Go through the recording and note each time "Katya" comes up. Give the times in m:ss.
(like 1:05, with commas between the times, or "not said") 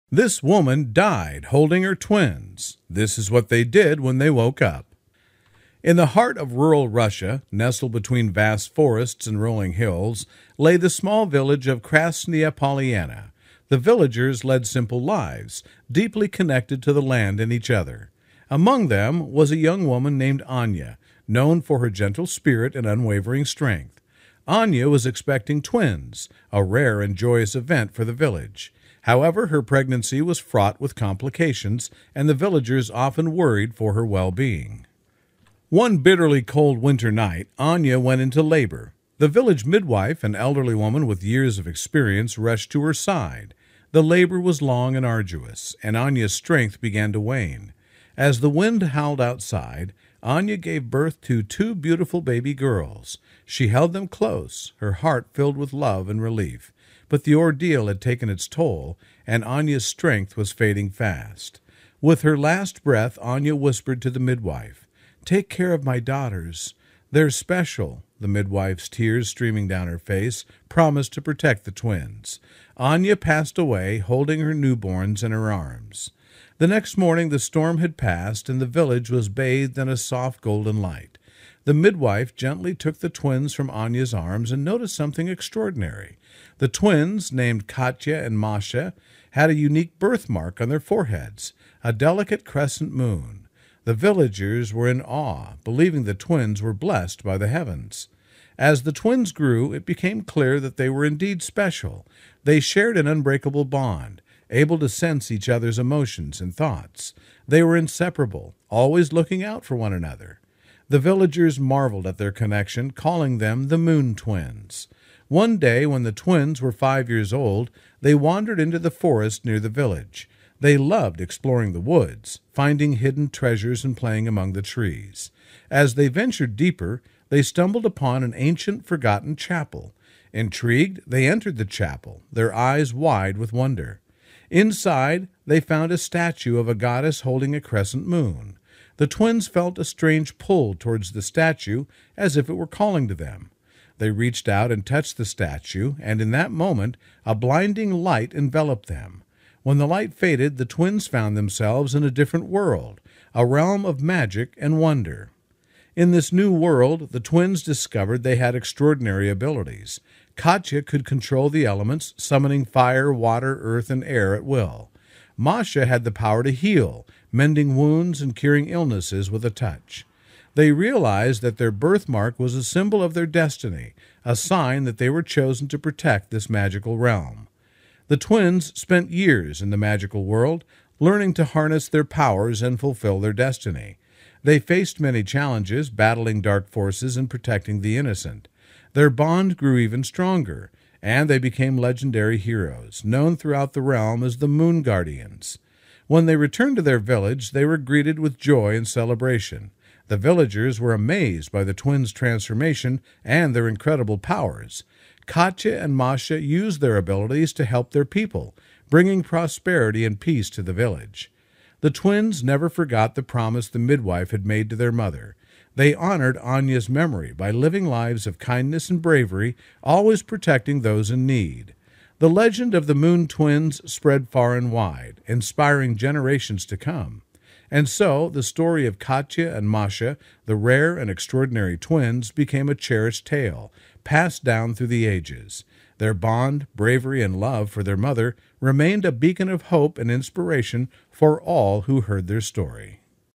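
1:27, 2:40, 3:25, 3:48.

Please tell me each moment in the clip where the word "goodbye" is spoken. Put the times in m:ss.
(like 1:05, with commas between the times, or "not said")
not said.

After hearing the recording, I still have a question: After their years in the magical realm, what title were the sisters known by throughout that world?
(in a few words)
Moon Guardians.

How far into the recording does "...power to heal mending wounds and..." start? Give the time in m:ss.
2:46.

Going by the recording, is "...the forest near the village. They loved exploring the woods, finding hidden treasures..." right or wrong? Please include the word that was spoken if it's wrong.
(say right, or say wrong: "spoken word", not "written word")
right.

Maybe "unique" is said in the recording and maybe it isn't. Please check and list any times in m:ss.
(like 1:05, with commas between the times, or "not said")
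1:29.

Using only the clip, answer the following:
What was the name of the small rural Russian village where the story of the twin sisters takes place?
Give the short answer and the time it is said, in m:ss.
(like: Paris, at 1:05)
Krasnaya Polyana, at 0:11.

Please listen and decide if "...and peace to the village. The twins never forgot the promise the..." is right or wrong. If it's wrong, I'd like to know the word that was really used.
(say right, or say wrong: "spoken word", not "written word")
right.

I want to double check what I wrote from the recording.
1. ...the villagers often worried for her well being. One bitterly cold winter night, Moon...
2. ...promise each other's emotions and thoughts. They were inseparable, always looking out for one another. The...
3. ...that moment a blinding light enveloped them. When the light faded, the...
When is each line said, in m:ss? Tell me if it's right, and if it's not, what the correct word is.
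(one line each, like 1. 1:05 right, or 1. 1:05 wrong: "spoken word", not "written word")
1. 0:32 wrong: "Anya", not "Moon"
2. 1:44 wrong: "sense", not "promise"
3. 2:26 right.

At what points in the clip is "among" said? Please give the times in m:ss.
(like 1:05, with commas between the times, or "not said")
0:18, 2:04.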